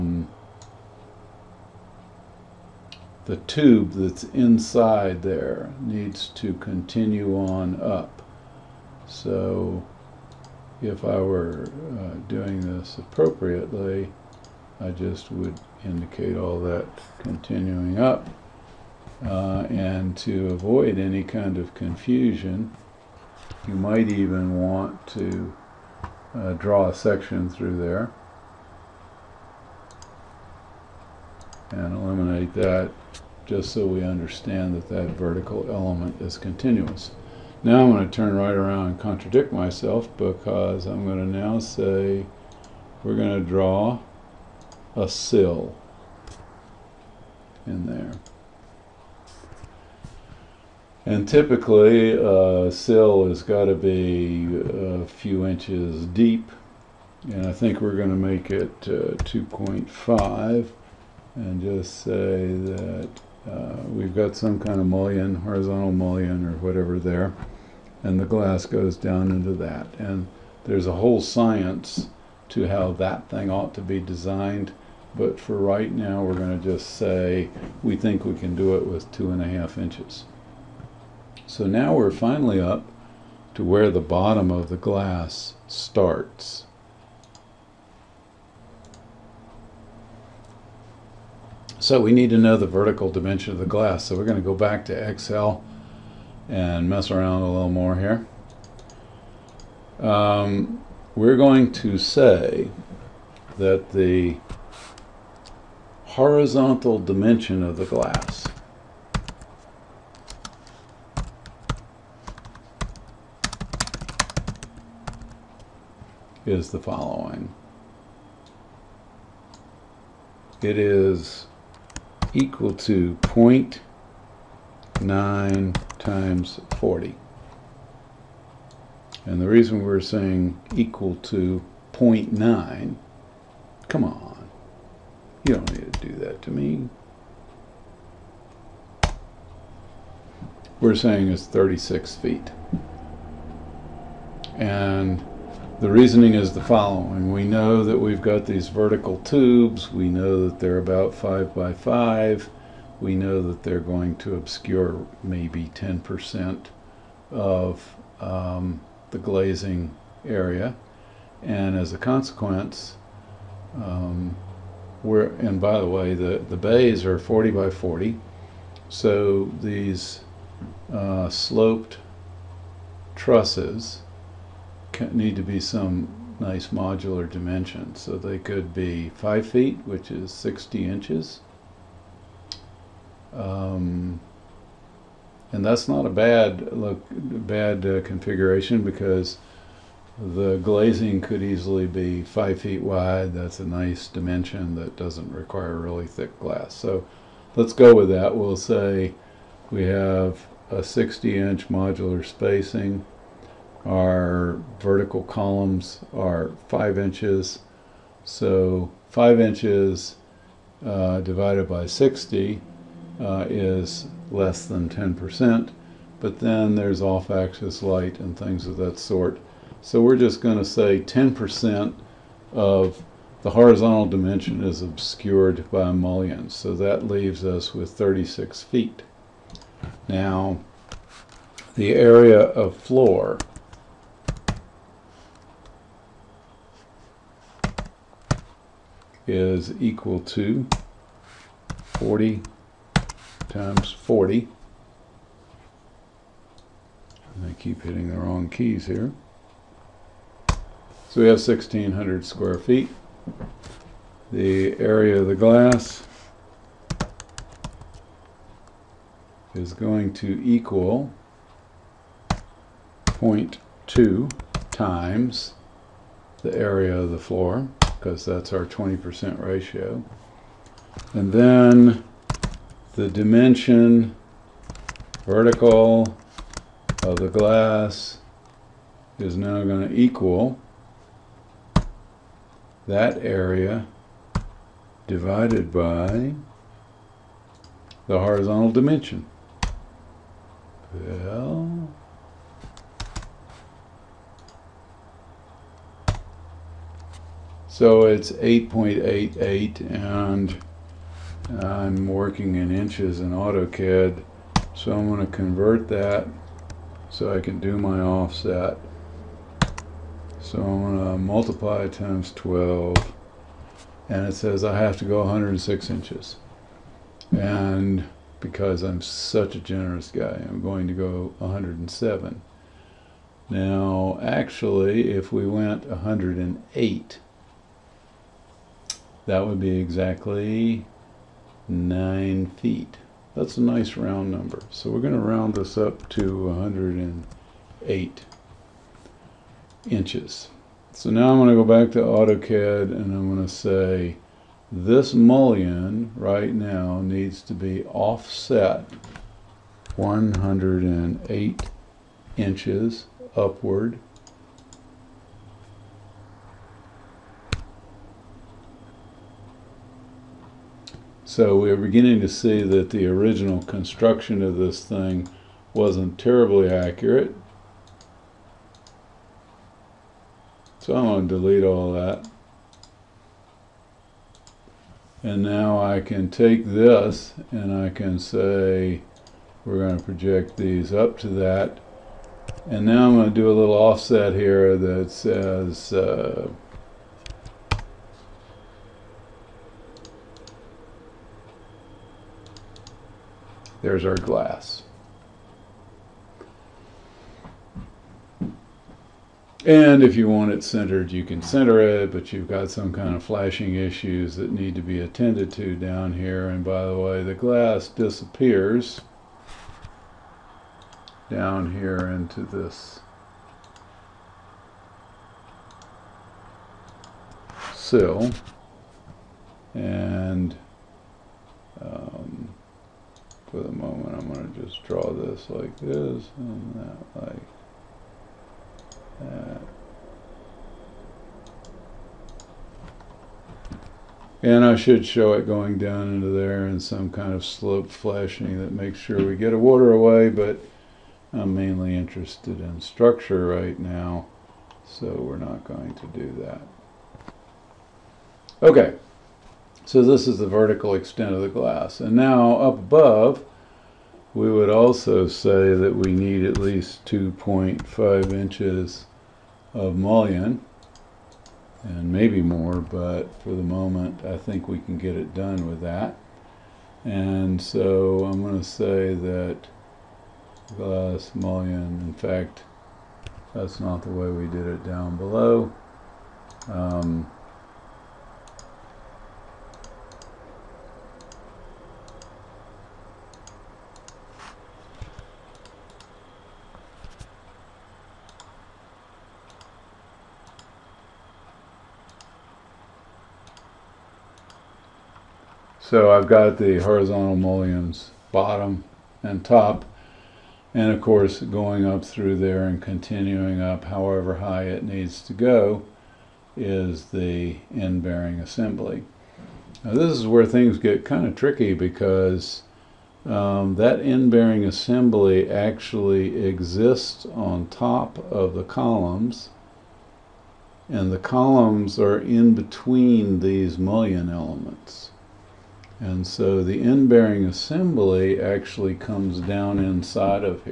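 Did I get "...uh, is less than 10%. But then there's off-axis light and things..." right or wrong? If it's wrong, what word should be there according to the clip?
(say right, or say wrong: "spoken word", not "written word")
right.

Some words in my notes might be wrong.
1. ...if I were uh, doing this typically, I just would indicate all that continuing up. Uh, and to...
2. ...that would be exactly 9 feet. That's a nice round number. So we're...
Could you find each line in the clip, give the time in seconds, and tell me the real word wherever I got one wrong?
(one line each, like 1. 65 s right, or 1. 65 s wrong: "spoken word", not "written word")
1. 10 s wrong: "appropriately", not "typically"
2. 329 s right.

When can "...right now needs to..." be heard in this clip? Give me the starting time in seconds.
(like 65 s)
346 s.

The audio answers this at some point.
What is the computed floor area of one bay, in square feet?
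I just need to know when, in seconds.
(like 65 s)
251 s.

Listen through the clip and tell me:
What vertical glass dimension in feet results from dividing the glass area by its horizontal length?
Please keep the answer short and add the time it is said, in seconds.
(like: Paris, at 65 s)
8.88, at 298 s.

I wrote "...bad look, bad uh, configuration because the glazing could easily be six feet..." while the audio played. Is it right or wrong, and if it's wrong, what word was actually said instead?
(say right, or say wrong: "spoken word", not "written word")
wrong: "five", not "six".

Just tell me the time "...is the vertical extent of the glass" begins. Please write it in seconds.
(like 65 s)
450 s.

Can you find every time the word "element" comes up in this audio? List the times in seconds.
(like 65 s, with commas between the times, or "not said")
35 s, 524 s.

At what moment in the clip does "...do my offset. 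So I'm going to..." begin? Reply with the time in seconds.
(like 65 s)
307 s.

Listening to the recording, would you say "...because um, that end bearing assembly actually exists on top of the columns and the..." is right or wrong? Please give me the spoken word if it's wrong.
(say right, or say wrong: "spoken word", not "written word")
right.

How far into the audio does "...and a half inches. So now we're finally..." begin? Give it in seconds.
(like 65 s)
79 s.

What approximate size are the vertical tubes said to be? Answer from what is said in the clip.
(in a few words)
5 by 5.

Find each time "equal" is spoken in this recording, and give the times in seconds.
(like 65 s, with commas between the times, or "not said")
122 s, 130 s, 239 s, 260 s, 279 s.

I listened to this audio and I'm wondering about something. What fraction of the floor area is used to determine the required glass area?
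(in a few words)
0.2.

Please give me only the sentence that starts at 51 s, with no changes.
And typically, a uh, sill has got to be a uh, few inches deep.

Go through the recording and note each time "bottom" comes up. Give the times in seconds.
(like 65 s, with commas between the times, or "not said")
84 s, 498 s.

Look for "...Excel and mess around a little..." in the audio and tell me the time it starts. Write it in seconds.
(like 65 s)
95 s.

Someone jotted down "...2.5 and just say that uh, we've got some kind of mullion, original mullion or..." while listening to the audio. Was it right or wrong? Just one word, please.
wrong.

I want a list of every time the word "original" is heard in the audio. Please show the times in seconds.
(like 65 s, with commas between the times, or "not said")
363 s.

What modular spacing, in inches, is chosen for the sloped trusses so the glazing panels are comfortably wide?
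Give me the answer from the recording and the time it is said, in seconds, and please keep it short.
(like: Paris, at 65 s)
60, at 180 s.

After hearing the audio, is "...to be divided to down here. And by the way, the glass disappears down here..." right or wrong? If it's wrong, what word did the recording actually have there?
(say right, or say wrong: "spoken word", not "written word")
wrong: "attended", not "divided".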